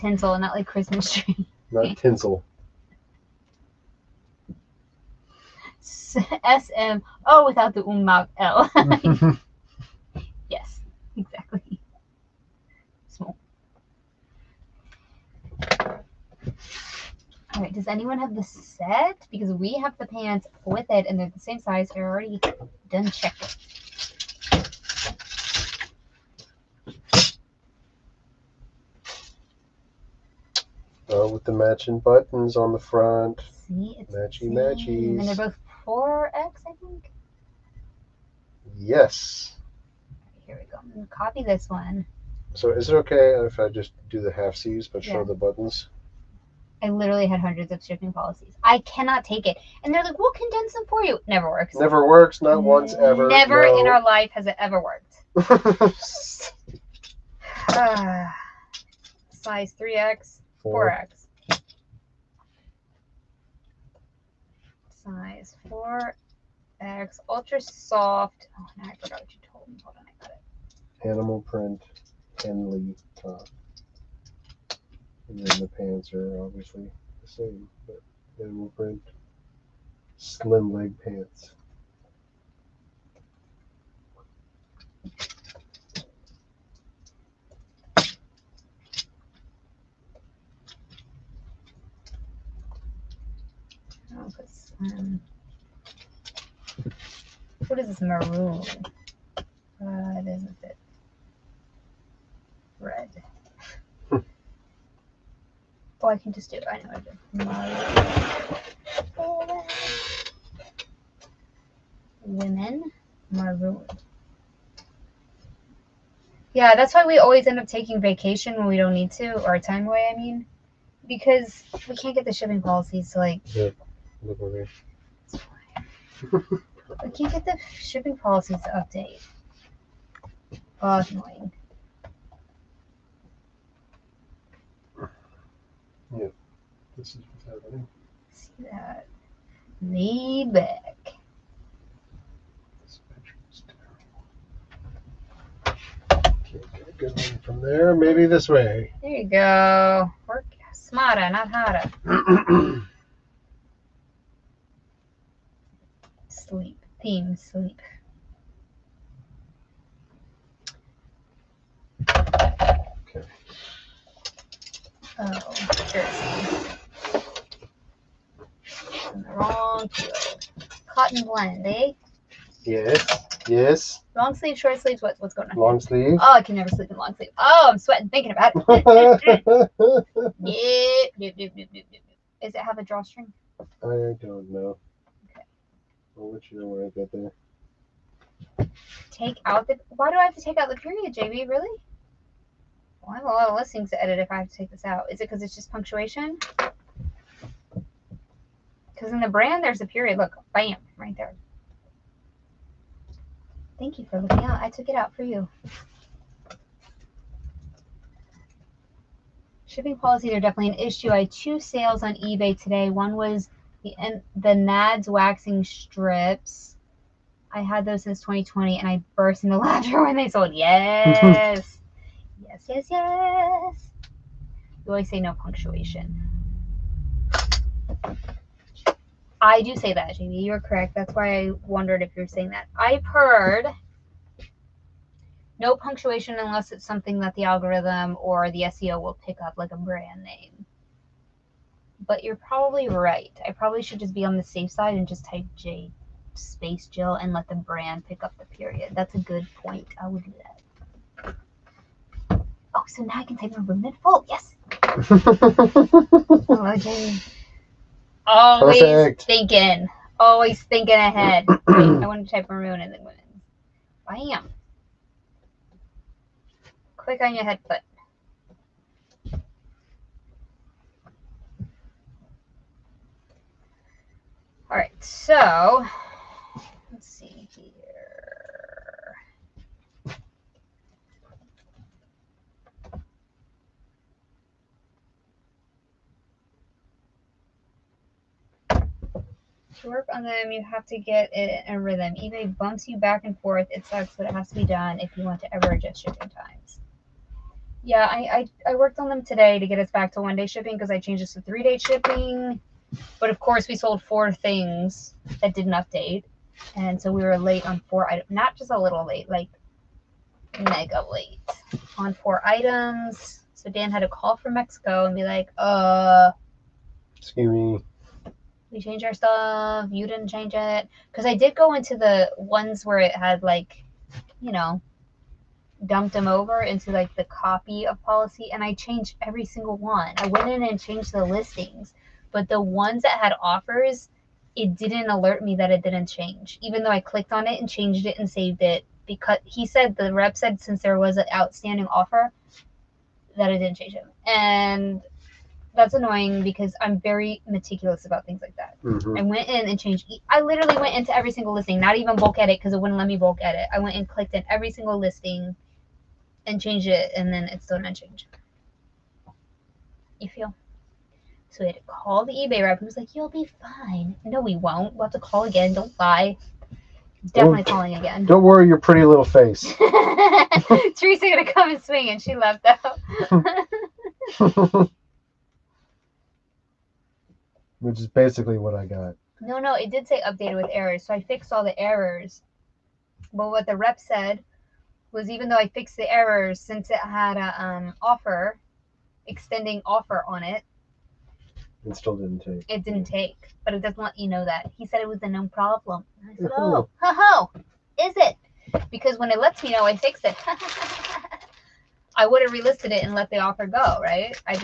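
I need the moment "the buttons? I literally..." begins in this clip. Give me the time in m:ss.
0:45.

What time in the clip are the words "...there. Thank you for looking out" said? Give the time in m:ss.
3:21.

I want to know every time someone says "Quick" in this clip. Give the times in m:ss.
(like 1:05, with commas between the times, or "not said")
4:26.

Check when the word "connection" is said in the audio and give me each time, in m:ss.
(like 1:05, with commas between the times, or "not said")
not said.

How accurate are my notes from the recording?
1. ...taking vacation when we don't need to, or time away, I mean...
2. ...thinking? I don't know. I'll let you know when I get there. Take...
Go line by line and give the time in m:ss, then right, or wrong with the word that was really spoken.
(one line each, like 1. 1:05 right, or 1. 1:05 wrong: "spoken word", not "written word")
1. 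1:57 right
2. 3:02 wrong: "drawstring", not "thinking".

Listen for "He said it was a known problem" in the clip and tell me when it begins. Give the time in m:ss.
6:34.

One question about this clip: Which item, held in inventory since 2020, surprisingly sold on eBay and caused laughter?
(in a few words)
NADS waxing strips.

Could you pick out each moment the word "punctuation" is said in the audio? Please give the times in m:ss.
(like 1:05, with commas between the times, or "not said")
3:15, 3:45, 3:55.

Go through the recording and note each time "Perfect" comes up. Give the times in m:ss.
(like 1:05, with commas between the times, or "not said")
4:18.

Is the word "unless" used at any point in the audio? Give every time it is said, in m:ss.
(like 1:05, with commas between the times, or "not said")
3:56.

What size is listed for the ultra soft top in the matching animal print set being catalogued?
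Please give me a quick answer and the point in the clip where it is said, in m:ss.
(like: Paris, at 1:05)
4X, at 1:05.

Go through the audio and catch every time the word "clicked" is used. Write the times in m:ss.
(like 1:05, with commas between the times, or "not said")
5:37, 5:54.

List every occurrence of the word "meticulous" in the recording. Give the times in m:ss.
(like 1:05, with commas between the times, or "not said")
5:47.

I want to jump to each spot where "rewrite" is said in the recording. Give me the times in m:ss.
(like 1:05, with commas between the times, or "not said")
not said.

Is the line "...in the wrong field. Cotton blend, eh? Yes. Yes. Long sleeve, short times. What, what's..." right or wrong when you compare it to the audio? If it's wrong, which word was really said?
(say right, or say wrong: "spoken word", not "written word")
wrong: "sleeves", not "times".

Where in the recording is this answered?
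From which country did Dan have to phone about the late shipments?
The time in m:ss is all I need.
5:14.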